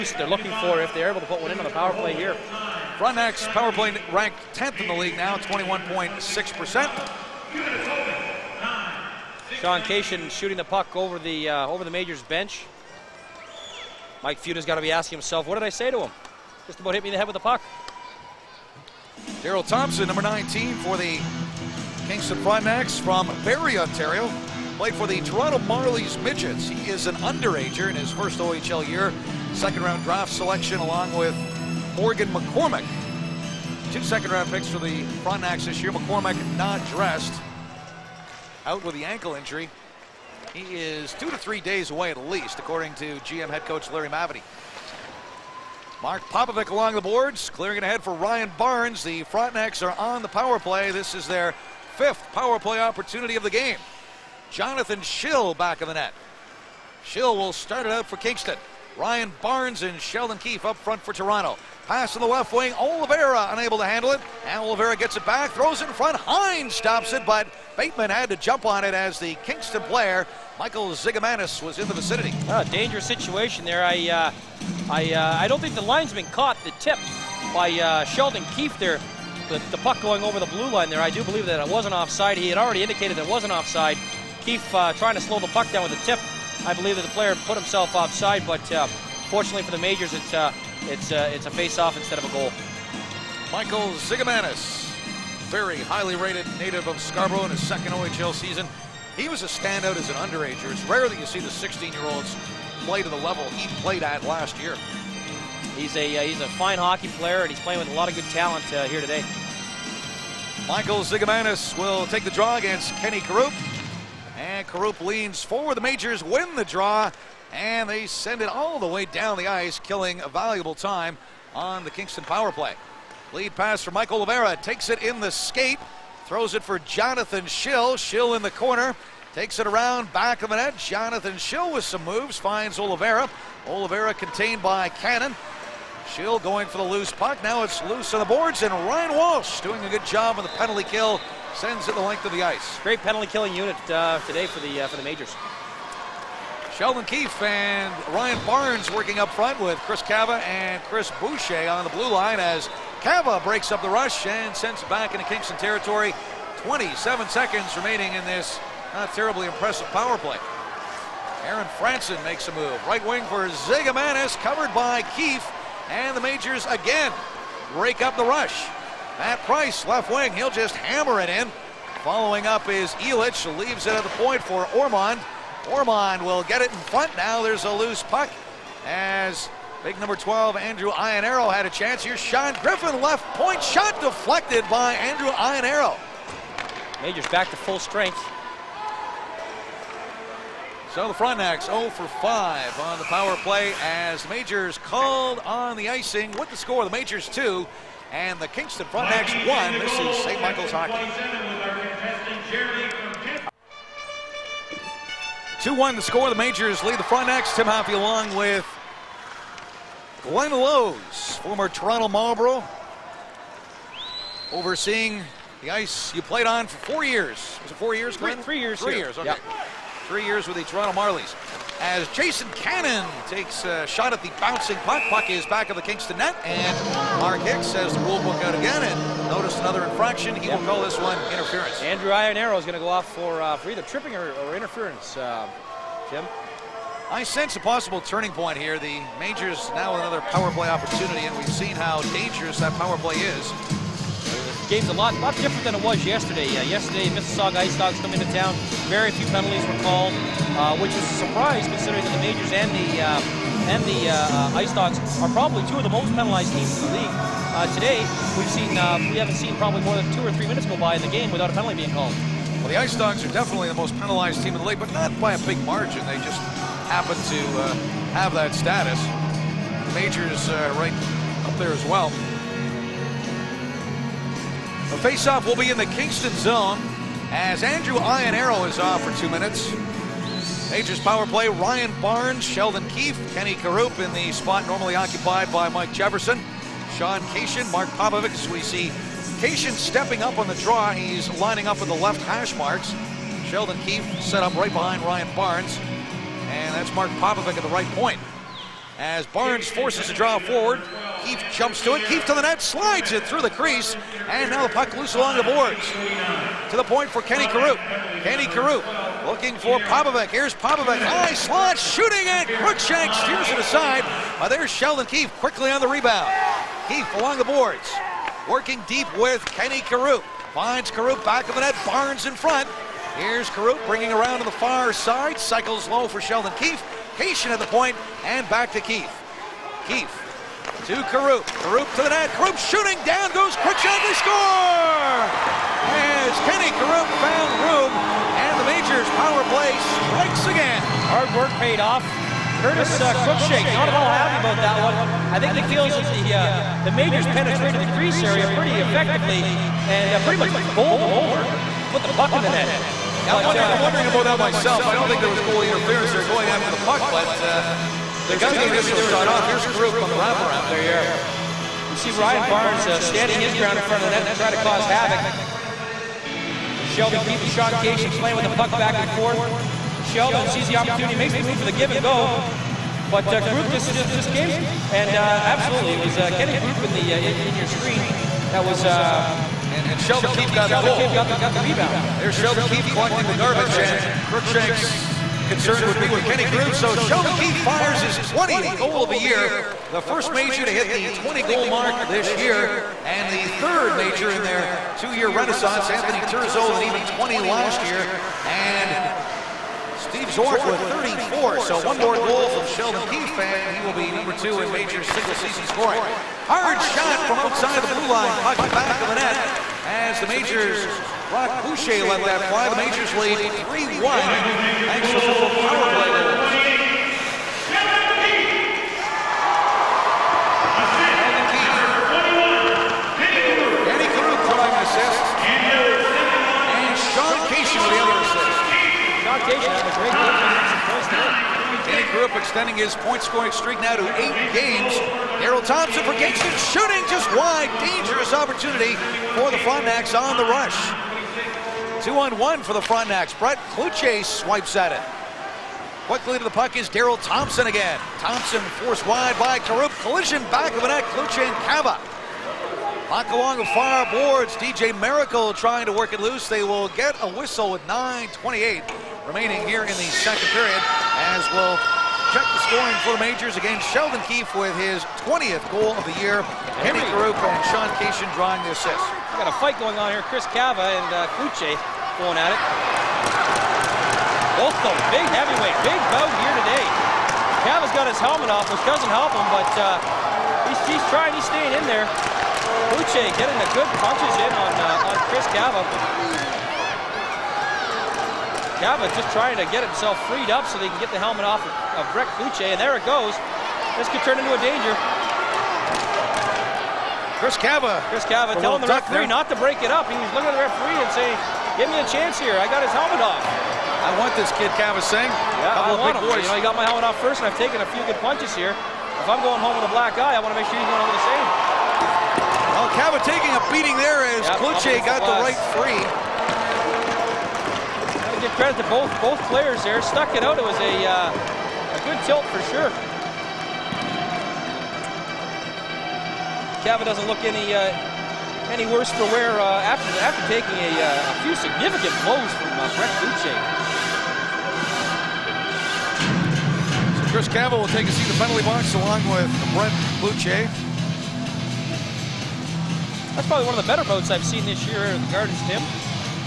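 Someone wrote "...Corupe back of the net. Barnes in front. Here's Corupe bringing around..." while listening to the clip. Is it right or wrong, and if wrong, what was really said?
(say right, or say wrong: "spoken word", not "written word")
right.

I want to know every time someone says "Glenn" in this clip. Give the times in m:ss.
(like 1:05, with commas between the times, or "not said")
3:30, 3:38.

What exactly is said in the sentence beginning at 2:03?
Lead pass for Michael Rivera, takes it in the skate, throws it for Jonathan Schill.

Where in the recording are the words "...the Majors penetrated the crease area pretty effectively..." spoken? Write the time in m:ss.
5:46.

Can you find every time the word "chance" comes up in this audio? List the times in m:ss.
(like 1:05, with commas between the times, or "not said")
3:01, 8:22.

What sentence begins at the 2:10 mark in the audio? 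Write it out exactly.
Jonathan Schill with some moves finds Oliveira.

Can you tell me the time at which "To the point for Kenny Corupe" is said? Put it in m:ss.
5:06.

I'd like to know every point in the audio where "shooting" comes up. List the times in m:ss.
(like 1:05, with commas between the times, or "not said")
0:10, 5:11, 5:32, 7:16.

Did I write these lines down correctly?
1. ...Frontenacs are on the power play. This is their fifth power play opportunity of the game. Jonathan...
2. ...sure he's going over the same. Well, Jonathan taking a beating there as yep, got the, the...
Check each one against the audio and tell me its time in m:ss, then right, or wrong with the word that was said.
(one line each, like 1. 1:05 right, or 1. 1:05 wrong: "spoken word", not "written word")
1. 0:49 right
2. 8:30 wrong: "Cava", not "Jonathan".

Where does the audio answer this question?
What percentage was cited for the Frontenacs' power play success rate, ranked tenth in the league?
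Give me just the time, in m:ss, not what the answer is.
0:05.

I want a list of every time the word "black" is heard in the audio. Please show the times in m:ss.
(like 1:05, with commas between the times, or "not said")
8:29.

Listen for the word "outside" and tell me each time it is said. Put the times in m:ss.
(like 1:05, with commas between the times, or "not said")
6:47.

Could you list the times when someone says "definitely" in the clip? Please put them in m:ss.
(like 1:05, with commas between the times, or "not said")
4:23.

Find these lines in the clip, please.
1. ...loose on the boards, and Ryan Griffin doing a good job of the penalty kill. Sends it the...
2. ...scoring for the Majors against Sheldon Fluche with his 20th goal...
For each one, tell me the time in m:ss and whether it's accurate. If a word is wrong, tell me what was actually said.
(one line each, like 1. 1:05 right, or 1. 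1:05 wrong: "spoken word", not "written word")
1. 2:17 wrong: "Walsh", not "Griffin"
2. 7:42 wrong: "Keefe", not "Fluche".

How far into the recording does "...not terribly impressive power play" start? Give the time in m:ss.
2:38.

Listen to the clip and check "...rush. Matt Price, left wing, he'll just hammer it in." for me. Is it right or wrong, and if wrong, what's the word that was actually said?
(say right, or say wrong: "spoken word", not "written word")
right.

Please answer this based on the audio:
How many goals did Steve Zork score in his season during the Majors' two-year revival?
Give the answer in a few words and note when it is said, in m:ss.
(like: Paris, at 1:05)
34, at 6:40.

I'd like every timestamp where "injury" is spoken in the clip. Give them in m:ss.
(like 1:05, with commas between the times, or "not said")
0:39.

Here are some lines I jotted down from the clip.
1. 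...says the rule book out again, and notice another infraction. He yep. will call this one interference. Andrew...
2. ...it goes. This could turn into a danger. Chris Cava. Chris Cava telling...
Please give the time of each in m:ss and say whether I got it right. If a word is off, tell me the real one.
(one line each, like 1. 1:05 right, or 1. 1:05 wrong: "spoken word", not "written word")
1. 3:47 right
2. 8:12 right.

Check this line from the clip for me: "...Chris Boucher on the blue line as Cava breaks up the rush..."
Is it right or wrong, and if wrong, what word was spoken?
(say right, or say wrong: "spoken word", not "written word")
right.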